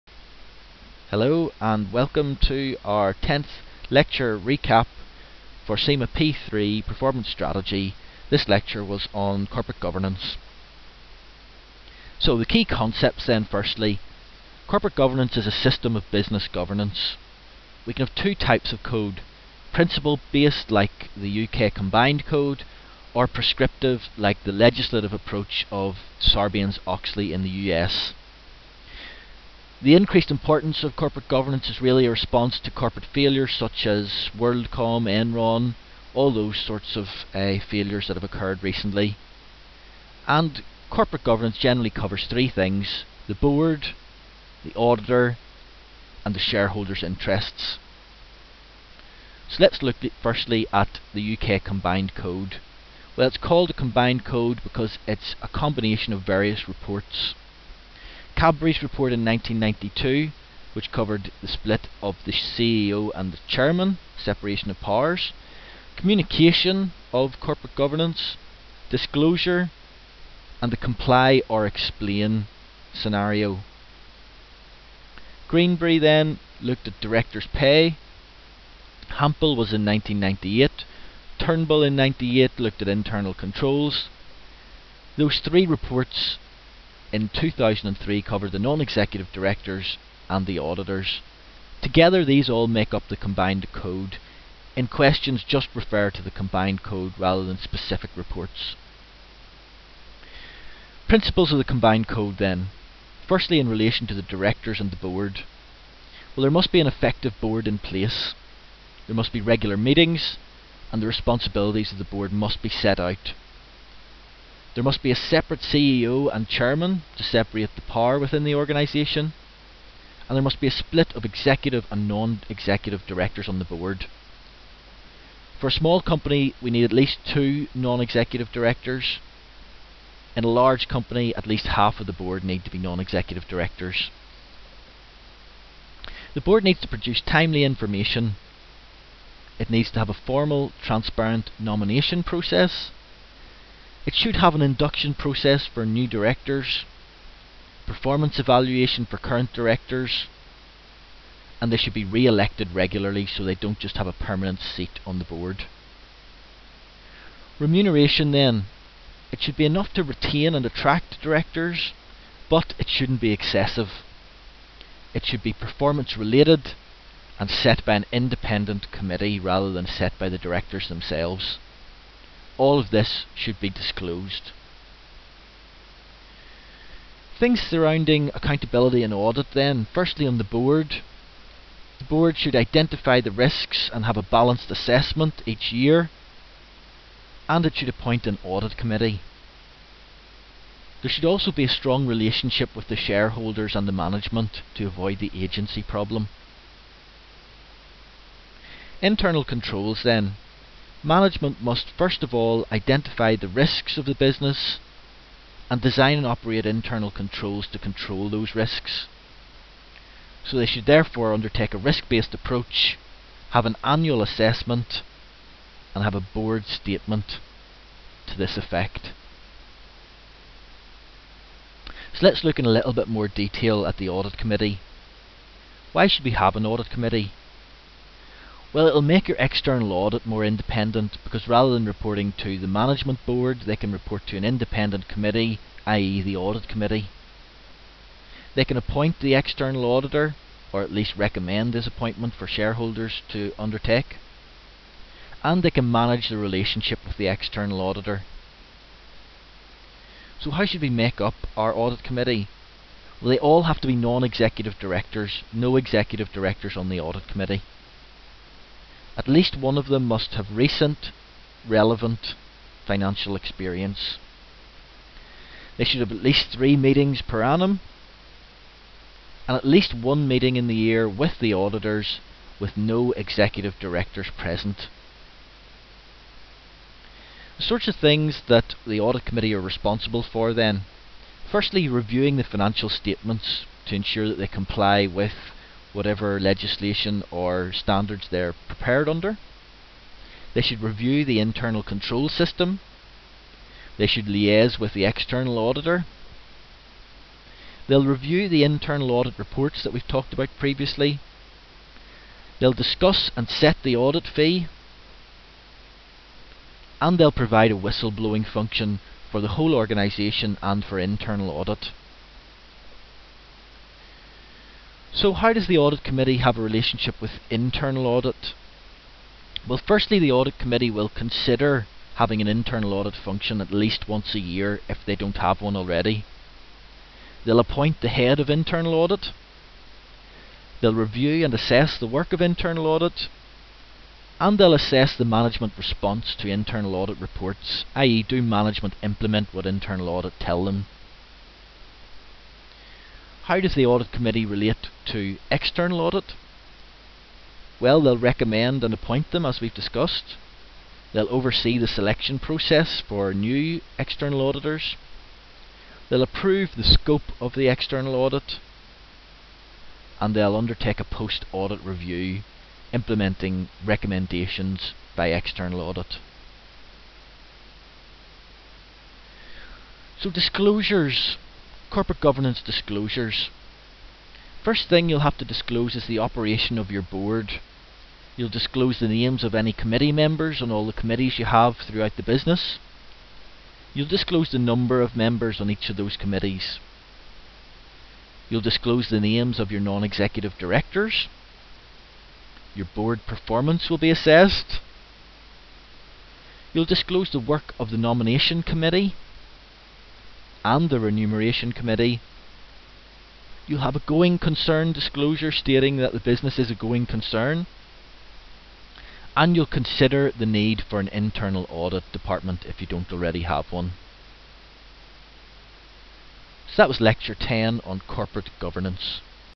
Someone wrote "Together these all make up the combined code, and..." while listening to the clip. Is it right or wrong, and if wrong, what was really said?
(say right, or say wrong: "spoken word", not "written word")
right.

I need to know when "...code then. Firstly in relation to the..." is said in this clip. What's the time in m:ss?
1:42.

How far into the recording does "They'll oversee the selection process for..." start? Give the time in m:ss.
5:51.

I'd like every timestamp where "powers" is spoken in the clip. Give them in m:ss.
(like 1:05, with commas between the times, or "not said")
1:04, 1:57.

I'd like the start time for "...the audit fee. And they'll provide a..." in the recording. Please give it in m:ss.
5:03.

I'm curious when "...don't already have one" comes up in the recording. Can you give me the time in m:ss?
6:52.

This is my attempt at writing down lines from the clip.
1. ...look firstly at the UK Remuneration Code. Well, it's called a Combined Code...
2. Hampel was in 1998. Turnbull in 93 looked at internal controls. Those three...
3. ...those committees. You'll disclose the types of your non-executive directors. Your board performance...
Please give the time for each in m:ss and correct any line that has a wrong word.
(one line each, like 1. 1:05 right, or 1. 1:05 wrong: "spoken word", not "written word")
1. 0:49 wrong: "Combined", not "Remuneration"
2. 1:19 wrong: "98", not "93"
3. 6:25 wrong: "names", not "types".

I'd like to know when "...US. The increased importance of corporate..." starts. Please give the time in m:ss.
0:27.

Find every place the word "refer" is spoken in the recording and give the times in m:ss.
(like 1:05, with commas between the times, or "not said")
1:35.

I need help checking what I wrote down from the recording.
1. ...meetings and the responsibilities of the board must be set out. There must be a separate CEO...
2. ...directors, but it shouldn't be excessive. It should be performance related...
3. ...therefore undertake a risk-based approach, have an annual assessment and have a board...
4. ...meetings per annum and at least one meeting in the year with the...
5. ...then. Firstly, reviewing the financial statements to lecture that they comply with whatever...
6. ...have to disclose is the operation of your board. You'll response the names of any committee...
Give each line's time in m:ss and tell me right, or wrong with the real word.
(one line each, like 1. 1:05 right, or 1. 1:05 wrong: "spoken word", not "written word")
1. 1:49 right
2. 2:41 right
3. 3:30 right
4. 4:26 right
5. 4:40 wrong: "ensure", not "lecture"
6. 6:15 wrong: "disclose", not "response".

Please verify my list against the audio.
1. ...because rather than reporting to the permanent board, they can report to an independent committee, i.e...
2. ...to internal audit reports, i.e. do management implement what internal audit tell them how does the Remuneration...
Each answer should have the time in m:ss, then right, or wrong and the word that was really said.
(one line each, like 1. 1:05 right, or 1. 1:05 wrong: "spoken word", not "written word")
1. 3:51 wrong: "management", not "permanent"
2. 5:36 wrong: "Audit", not "Remuneration".